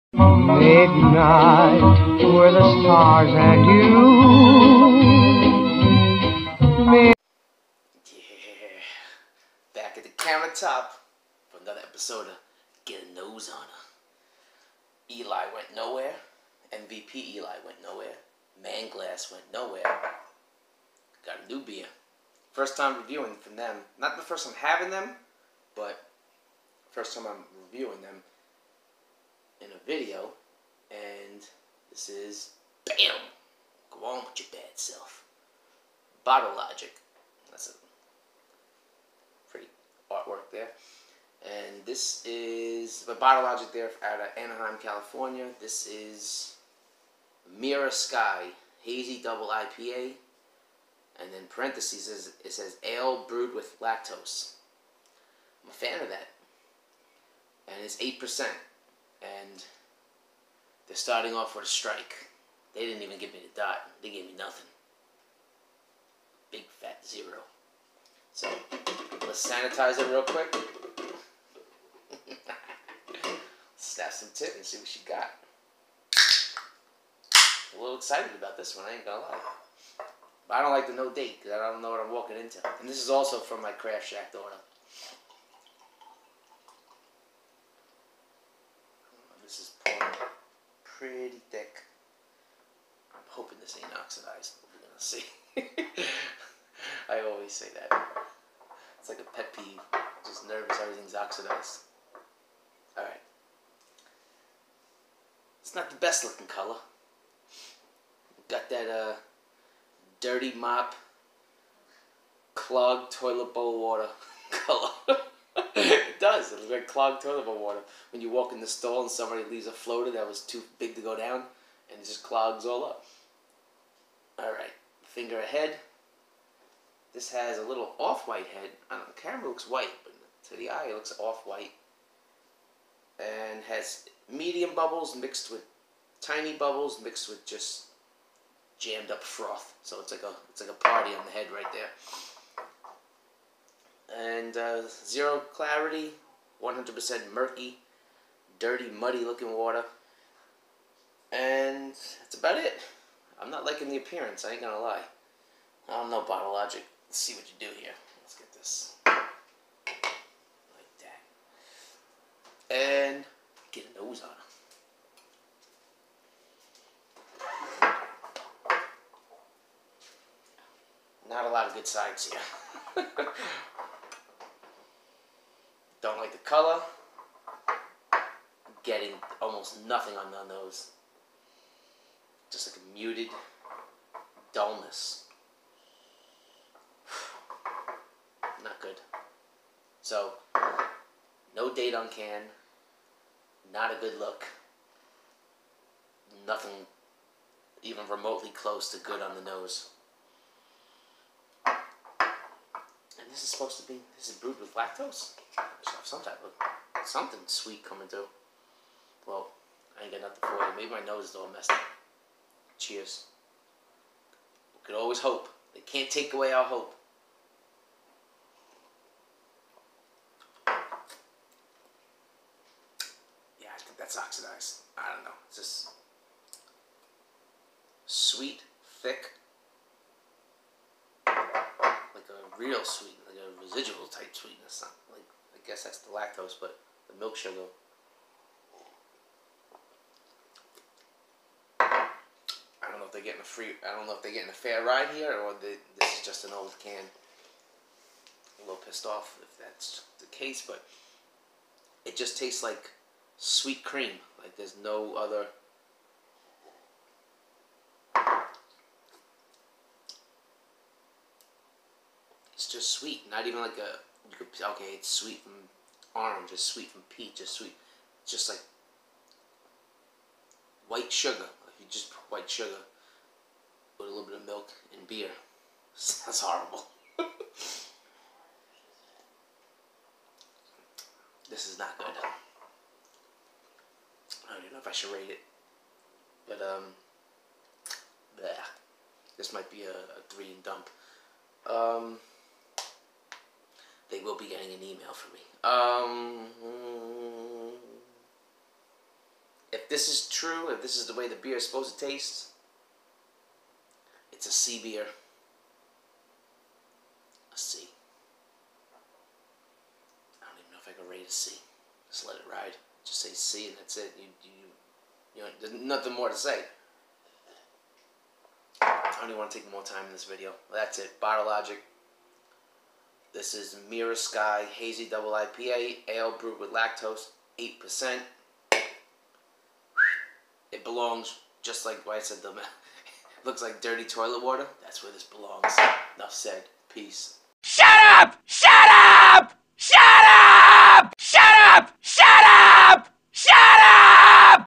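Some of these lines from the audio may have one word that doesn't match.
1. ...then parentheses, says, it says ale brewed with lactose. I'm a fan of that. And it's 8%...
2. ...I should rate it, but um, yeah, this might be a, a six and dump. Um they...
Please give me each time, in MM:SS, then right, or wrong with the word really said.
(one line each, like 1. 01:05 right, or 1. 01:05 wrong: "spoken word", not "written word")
1. 00:51 right
2. 04:44 wrong: "three", not "six".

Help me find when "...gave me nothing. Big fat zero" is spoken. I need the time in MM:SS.
01:04.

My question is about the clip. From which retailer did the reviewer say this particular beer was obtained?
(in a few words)
Craft Shack.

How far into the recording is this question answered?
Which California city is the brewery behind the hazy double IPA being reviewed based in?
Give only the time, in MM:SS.
00:44.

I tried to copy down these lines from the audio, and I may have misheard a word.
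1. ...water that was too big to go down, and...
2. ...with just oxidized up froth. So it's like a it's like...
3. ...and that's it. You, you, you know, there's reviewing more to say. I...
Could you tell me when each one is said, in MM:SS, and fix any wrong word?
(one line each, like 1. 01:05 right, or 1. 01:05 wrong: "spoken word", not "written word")
1. 01:59 wrong: "floater", not "water"
2. 02:17 wrong: "jammed", not "oxidized"
3. 05:13 wrong: "nothing", not "reviewing".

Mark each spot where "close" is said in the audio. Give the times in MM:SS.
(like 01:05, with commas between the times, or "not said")
03:18.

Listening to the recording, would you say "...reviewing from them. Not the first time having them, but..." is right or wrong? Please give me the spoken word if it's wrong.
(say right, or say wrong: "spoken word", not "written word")
right.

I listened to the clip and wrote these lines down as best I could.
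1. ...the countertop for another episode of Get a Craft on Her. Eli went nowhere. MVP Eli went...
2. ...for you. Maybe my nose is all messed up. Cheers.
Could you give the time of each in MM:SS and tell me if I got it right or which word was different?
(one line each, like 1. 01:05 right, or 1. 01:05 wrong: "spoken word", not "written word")
1. 00:10 wrong: "Nose", not "Craft"
2. 03:30 right.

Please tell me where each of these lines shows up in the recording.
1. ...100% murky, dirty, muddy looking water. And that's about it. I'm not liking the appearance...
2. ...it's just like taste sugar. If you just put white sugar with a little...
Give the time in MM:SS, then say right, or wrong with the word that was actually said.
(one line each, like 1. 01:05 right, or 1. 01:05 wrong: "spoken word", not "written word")
1. 02:26 right
2. 04:28 wrong: "white", not "taste".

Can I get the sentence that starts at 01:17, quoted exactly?
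a little excited about this one, I ain't gonna lie.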